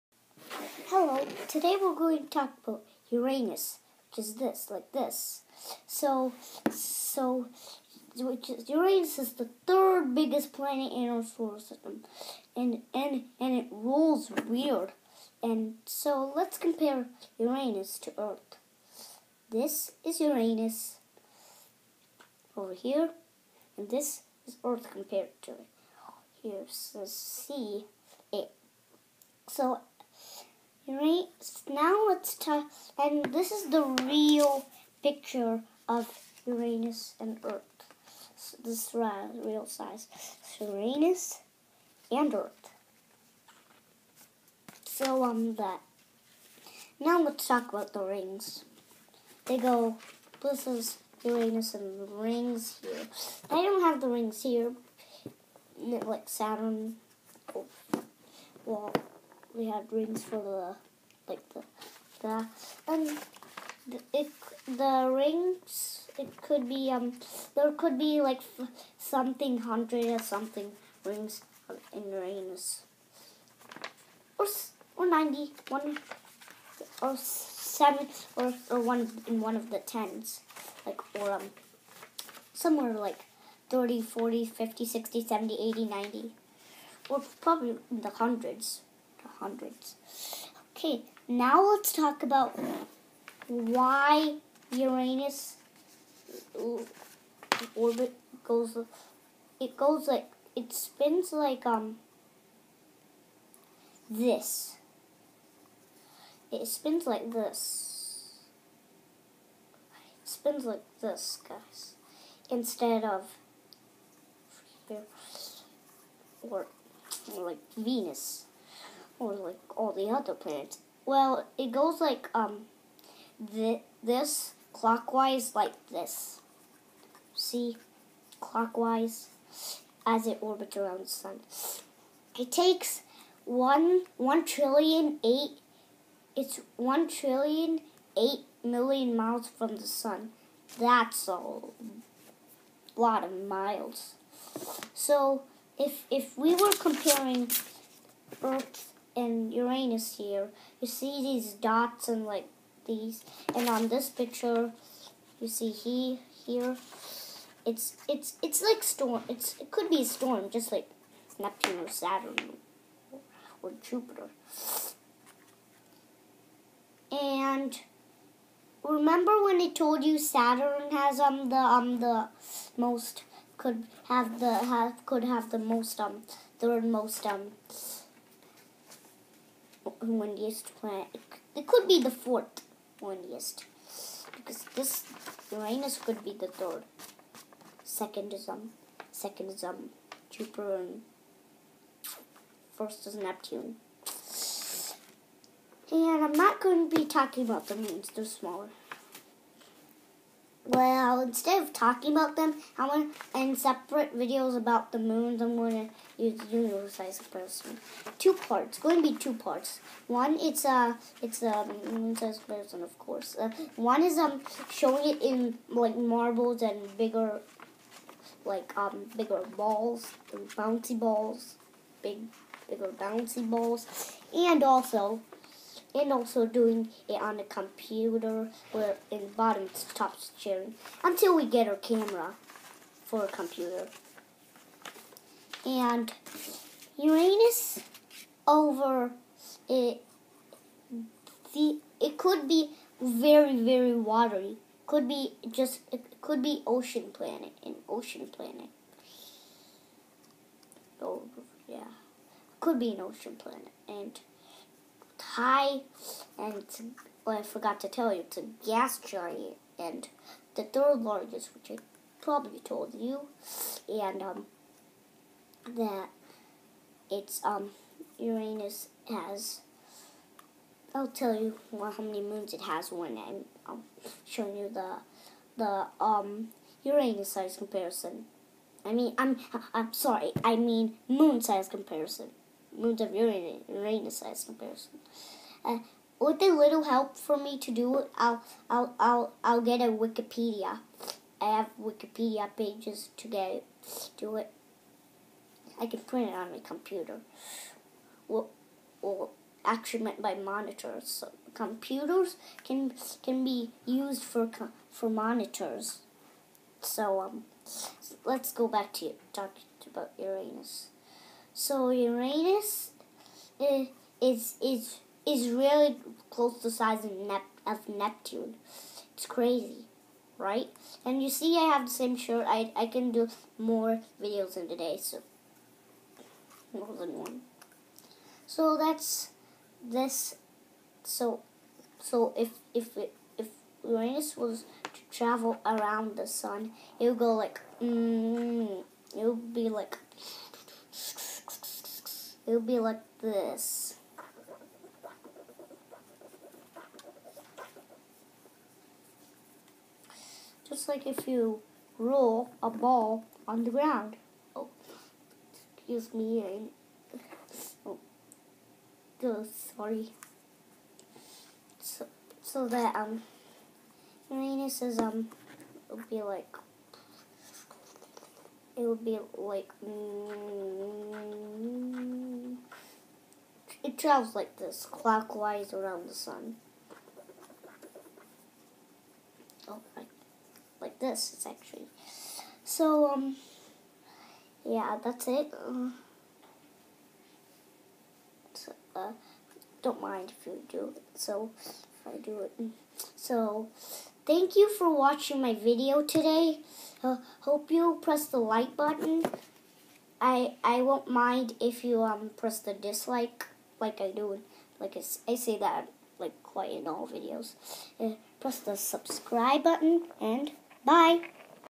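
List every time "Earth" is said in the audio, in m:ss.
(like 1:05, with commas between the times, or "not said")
0:18, 0:24, 0:37, 0:42, 2:28.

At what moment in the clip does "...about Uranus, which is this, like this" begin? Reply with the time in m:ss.
0:02.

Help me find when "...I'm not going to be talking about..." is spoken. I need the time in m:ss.
3:16.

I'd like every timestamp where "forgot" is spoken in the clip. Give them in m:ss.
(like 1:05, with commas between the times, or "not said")
4:17.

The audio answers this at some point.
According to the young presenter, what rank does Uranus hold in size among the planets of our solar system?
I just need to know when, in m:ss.
0:09.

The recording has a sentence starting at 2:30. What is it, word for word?
You see these dots and like these, and on this picture, you see he here.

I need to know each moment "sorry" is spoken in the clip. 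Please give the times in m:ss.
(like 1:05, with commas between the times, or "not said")
4:39, 5:59.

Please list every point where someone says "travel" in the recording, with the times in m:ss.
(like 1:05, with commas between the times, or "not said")
5:35, 6:13.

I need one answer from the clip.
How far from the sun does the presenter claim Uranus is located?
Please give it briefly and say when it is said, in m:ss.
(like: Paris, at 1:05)
one trillion eight million miles, at 2:16.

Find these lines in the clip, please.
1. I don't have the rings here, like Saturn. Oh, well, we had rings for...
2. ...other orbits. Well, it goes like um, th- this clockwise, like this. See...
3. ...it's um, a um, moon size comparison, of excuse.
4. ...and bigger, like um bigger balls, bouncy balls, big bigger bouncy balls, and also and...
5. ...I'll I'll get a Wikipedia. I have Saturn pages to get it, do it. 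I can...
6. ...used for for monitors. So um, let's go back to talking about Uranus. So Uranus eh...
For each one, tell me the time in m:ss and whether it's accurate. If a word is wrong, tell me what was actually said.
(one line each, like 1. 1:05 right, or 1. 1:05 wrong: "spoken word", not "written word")
1. 0:53 right
2. 2:00 wrong: "planets", not "orbits"
3. 3:31 wrong: "course", not "excuse"
4. 3:36 right
5. 4:48 wrong: "Wikipedia", not "Saturn"
6. 5:03 right.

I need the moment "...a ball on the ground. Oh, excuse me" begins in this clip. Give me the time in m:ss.
5:52.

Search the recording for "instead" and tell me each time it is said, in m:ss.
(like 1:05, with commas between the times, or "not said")
1:52, 3:21.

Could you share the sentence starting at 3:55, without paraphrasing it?
And Uranus over it, the, it could be very, very watery.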